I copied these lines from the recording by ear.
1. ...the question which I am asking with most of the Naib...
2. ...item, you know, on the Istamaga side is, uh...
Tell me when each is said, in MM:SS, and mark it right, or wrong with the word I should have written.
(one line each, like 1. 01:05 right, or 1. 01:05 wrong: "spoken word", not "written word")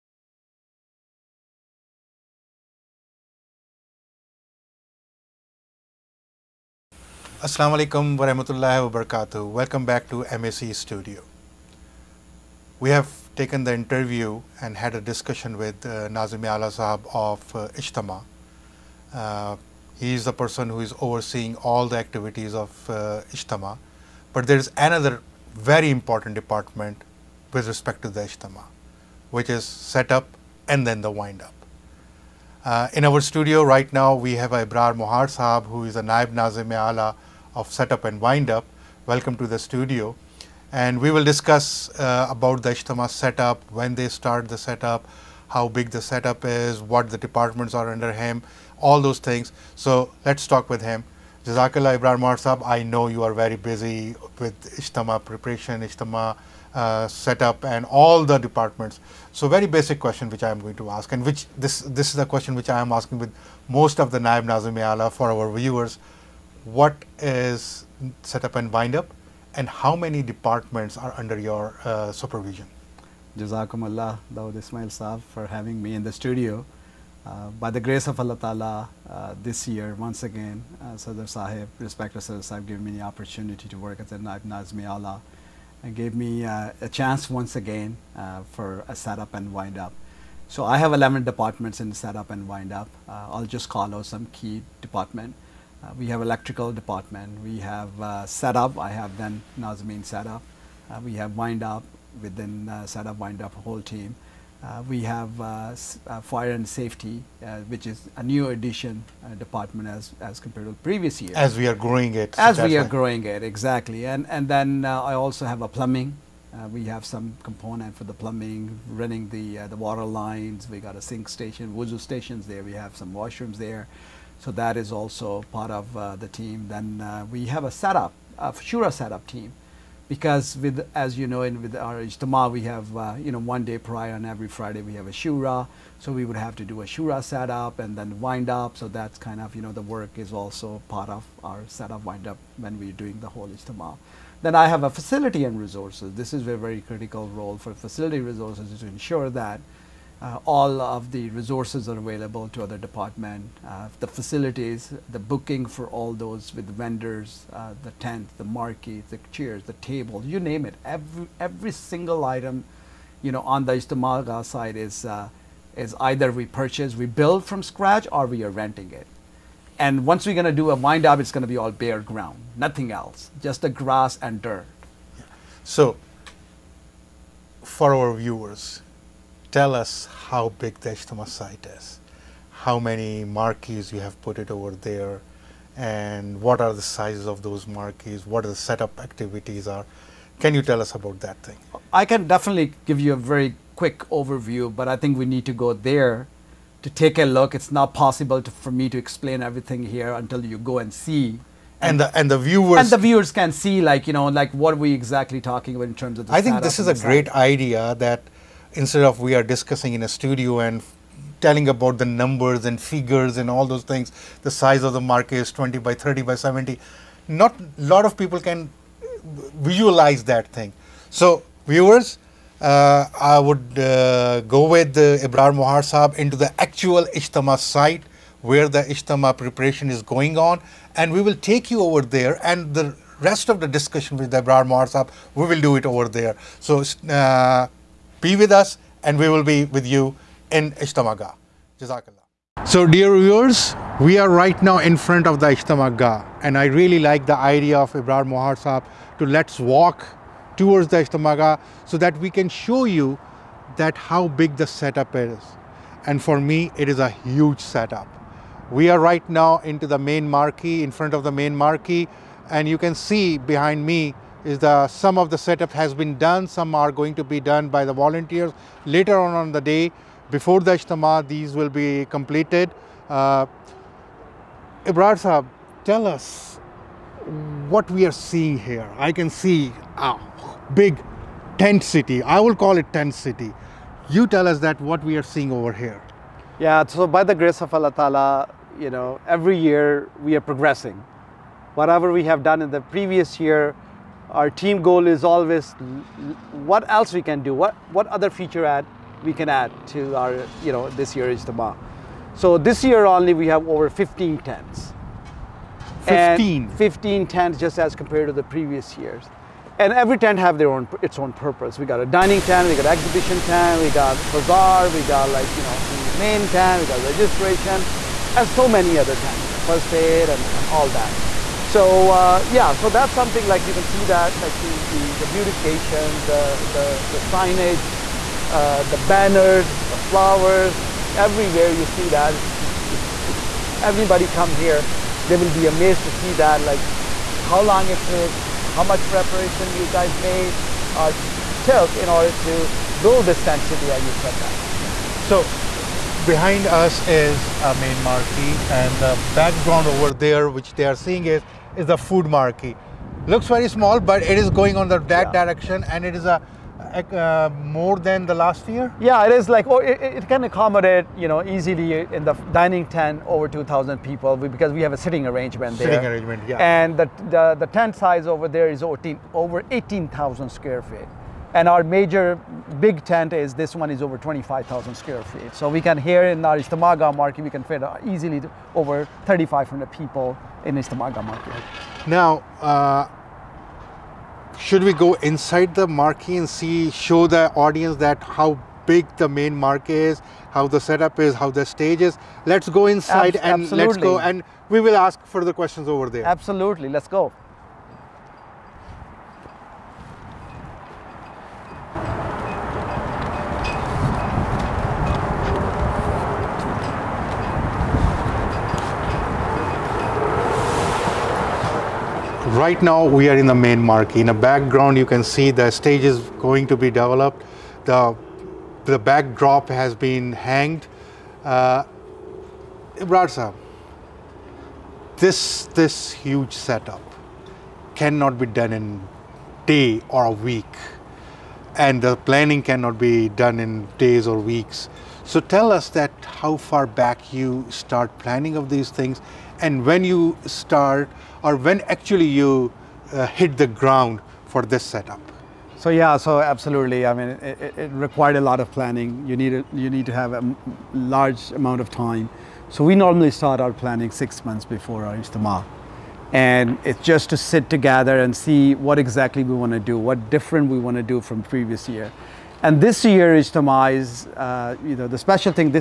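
1. 01:02 right
2. 02:42 right.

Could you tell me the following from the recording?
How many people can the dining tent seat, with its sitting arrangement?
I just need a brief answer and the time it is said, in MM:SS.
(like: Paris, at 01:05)
2000, at 06:03.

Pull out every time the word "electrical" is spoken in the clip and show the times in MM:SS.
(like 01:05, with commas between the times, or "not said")
01:36.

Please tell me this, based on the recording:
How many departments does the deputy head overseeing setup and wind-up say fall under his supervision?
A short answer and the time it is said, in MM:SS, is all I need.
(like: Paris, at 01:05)
11, at 01:30.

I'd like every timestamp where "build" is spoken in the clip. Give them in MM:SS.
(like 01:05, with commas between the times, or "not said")
02:47, 05:43.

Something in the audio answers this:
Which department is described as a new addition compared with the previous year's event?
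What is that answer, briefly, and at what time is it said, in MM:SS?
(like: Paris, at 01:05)
fire and safety, at 01:46.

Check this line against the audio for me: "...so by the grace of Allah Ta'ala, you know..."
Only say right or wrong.
right.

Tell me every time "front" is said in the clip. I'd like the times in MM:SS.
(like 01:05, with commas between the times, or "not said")
04:04, 04:20.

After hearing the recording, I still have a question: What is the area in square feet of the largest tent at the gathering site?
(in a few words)
25,000 square feet.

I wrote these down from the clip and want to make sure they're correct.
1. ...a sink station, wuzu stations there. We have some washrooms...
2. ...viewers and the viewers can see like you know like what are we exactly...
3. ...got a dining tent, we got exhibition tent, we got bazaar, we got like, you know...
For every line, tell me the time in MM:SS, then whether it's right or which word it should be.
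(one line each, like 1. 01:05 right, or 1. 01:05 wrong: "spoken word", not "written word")
1. 02:00 right
2. 03:22 right
3. 05:11 right.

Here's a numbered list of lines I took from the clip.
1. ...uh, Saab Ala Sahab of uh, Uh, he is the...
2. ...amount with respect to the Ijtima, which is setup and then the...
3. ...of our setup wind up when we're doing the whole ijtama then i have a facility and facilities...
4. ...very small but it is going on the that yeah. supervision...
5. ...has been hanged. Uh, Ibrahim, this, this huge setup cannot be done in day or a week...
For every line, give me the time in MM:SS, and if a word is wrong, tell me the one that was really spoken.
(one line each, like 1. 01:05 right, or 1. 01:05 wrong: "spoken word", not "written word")
1. 00:15 wrong: "Nazim", not "Saab"
2. 00:26 wrong: "department", not "amount"
3. 02:21 wrong: "resources", not "facilities"
4. 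05:53 wrong: "direction", not "supervision"
5. 06:59 right.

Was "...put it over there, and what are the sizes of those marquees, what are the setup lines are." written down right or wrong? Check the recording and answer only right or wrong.
wrong.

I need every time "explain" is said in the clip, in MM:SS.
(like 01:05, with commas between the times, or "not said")
03:18.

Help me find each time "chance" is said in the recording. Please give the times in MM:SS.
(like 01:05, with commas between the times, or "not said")
01:26.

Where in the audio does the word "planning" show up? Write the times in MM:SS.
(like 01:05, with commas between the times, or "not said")
07:12, 07:18, 07:28, 07:33.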